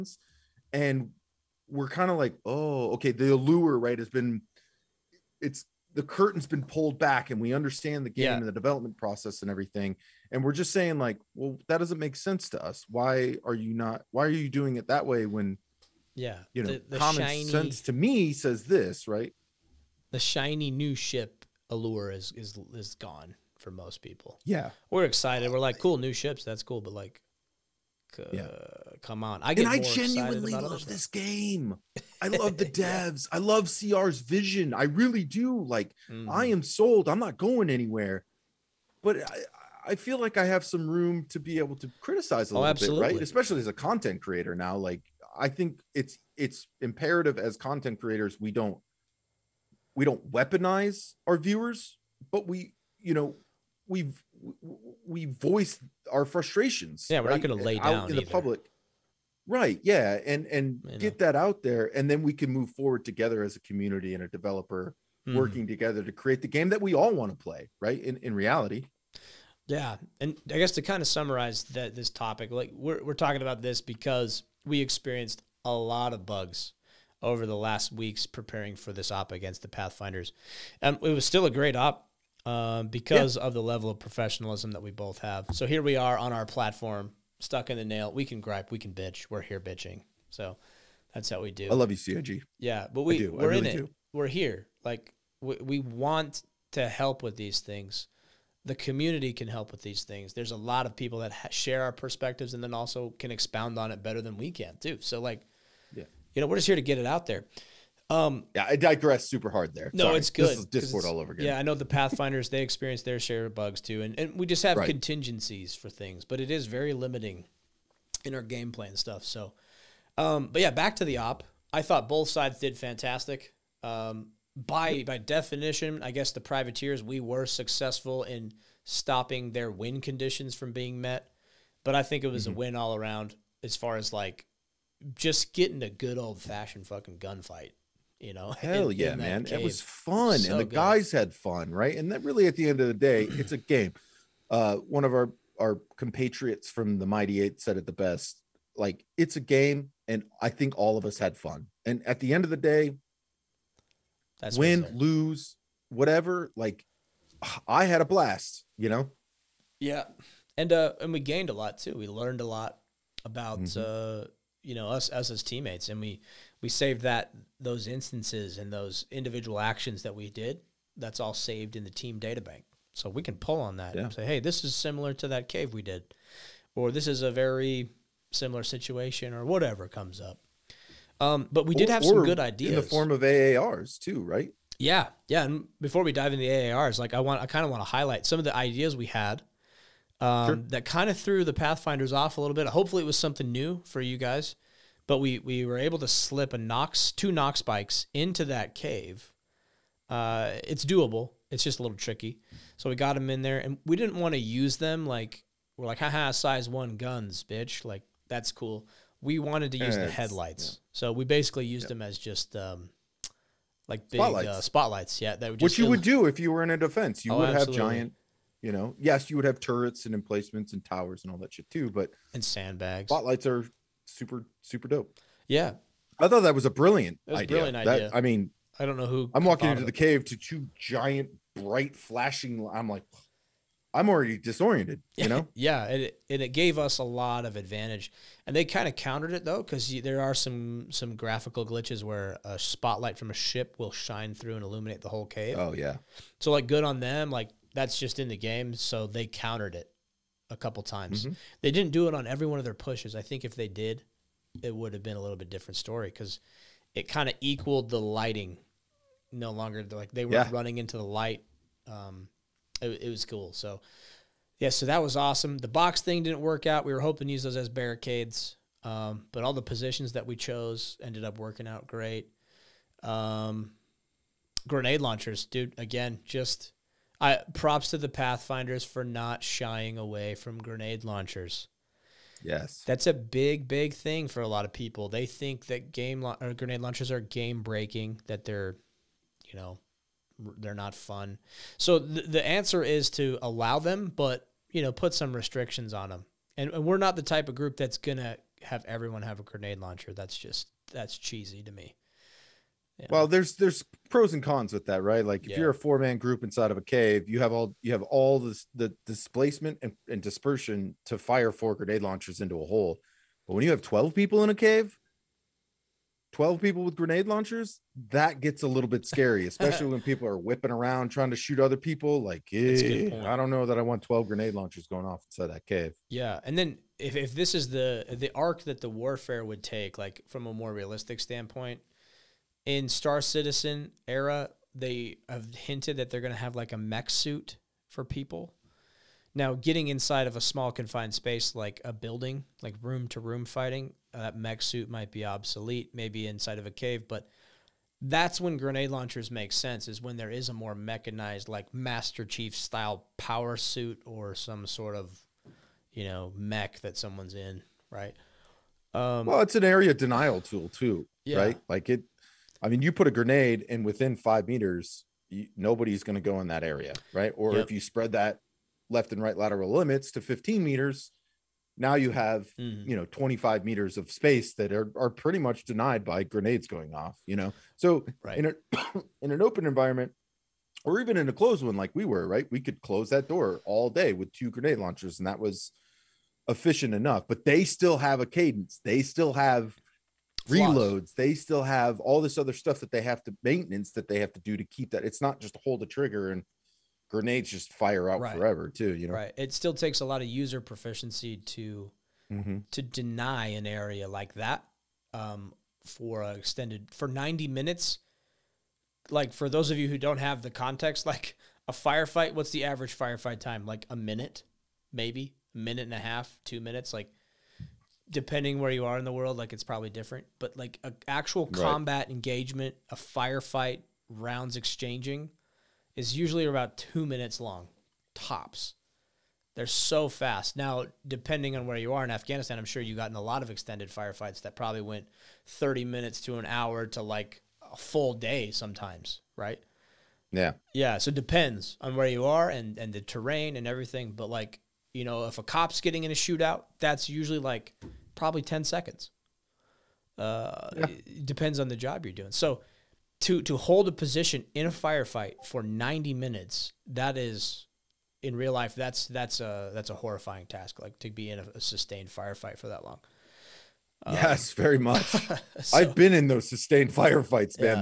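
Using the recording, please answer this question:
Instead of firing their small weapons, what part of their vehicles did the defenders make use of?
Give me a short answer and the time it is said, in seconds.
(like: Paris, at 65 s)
headlights, at 210 s.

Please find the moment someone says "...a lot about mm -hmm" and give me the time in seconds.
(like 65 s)
162 s.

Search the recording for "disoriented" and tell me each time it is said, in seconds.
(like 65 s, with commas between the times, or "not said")
234 s.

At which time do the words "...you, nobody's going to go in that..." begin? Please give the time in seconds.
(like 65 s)
365 s.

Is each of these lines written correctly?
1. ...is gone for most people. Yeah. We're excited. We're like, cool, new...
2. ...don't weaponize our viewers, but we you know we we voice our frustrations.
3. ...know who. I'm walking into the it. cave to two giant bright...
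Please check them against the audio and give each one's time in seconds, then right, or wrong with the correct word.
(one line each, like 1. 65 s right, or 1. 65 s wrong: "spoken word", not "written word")
1. 22 s right
2. 50 s right
3. 228 s right.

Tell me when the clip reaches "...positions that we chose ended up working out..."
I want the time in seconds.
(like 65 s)
269 s.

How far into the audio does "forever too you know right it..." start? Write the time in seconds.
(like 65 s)
398 s.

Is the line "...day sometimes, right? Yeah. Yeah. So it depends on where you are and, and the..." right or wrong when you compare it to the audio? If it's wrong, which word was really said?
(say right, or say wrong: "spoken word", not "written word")
right.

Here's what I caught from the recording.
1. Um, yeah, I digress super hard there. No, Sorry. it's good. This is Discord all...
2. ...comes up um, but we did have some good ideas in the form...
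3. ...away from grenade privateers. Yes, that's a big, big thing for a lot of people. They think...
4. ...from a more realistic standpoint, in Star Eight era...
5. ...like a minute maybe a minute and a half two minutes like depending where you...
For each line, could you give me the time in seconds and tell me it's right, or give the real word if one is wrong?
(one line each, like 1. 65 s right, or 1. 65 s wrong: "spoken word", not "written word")
1. 108 s right
2. 179 s right
3. 279 s wrong: "launchers", not "privateers"
4. 330 s wrong: "Citizen", not "Eight"
5. 413 s right.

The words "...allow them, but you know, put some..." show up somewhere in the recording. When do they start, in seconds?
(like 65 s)
293 s.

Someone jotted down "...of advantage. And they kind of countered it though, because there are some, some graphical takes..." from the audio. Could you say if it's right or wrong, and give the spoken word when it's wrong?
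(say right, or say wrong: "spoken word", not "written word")
wrong: "glitches", not "takes".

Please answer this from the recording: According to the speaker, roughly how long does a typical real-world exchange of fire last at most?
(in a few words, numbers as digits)
2 minutes.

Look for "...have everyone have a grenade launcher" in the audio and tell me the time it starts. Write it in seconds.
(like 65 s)
298 s.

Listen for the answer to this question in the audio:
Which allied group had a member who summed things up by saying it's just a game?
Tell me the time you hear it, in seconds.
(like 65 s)
147 s.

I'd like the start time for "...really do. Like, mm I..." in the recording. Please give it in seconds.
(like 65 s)
34 s.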